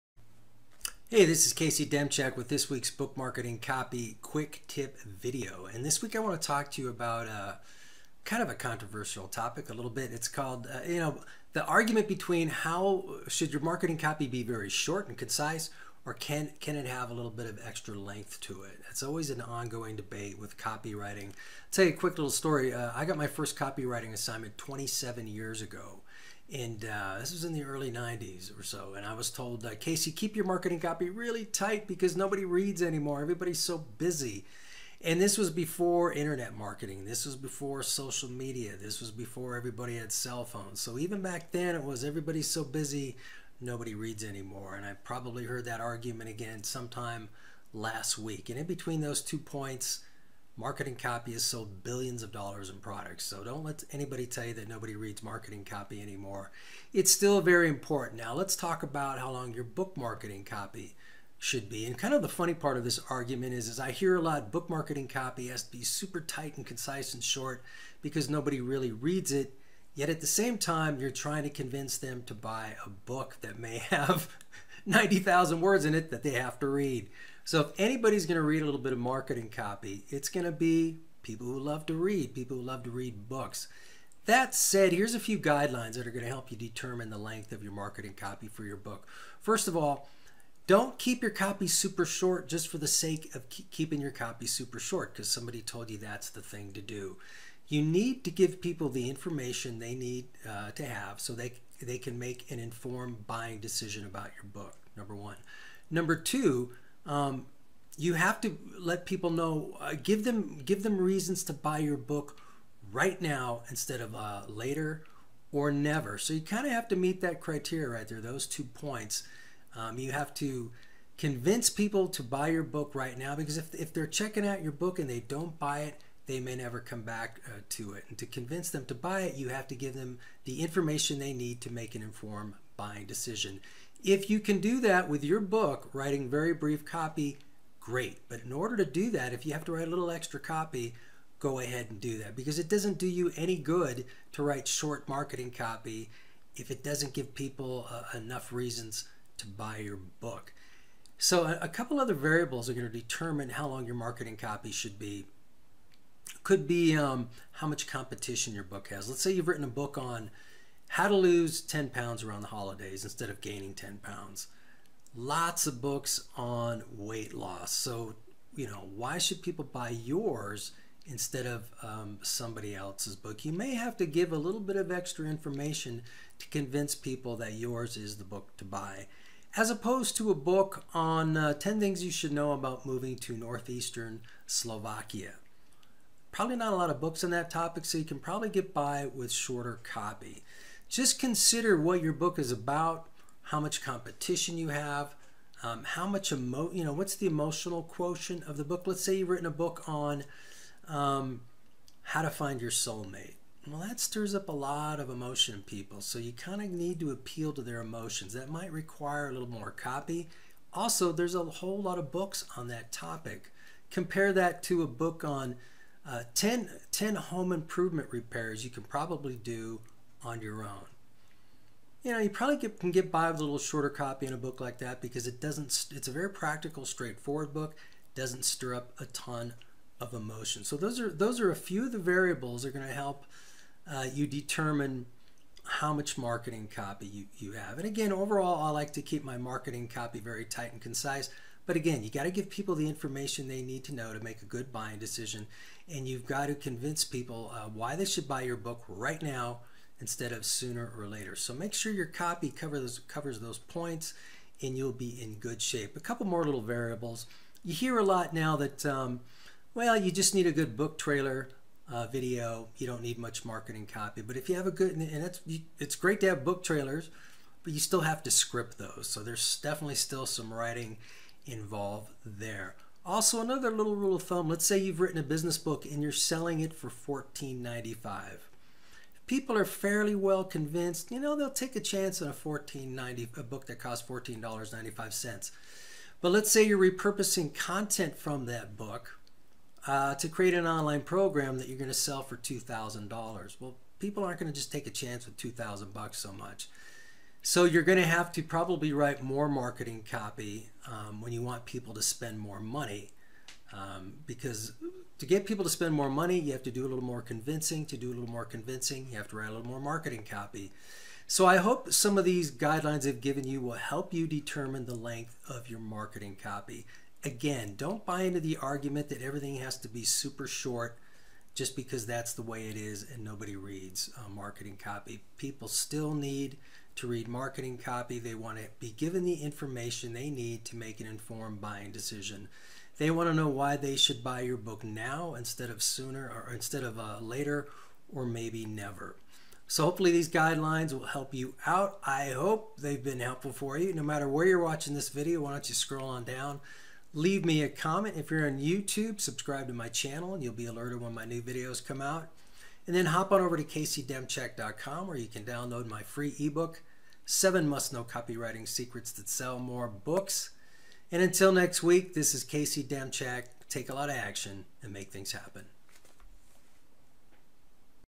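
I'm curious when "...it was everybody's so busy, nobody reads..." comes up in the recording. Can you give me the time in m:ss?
0:41.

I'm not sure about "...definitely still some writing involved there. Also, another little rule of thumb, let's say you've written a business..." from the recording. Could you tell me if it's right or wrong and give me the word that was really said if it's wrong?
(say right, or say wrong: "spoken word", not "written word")
right.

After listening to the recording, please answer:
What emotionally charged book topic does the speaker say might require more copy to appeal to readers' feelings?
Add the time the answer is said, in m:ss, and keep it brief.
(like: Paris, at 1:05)
how to find your soulmate, at 3:22.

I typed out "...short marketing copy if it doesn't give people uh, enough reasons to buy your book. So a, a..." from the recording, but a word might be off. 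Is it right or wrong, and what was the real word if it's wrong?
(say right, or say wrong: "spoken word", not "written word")
right.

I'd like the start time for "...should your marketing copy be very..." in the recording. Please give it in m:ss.
0:13.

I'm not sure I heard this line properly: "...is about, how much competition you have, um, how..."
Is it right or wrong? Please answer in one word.
right.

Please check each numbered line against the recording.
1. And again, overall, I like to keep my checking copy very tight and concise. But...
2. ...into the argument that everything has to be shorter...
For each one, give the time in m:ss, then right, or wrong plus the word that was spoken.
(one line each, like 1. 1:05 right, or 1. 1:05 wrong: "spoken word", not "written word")
1. 3:57 wrong: "marketing", not "checking"
2. 5:18 wrong: "super", not "shorter".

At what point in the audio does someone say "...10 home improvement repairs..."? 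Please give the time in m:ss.
3:36.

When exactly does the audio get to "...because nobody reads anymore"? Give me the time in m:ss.
0:31.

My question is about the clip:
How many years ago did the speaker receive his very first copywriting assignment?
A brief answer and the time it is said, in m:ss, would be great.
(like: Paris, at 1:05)
27, at 0:24.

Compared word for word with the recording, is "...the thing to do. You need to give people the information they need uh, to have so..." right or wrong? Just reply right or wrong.
right.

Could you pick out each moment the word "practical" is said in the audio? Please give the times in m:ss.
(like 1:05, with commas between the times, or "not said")
3:46.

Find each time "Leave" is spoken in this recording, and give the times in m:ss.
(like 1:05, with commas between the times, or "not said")
5:47.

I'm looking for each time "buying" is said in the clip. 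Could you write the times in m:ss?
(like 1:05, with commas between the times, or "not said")
1:43, 2:12, 4:04, 5:31.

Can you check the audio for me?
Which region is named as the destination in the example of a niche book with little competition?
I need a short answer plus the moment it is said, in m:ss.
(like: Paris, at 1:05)
northeastern Slovakia, at 3:03.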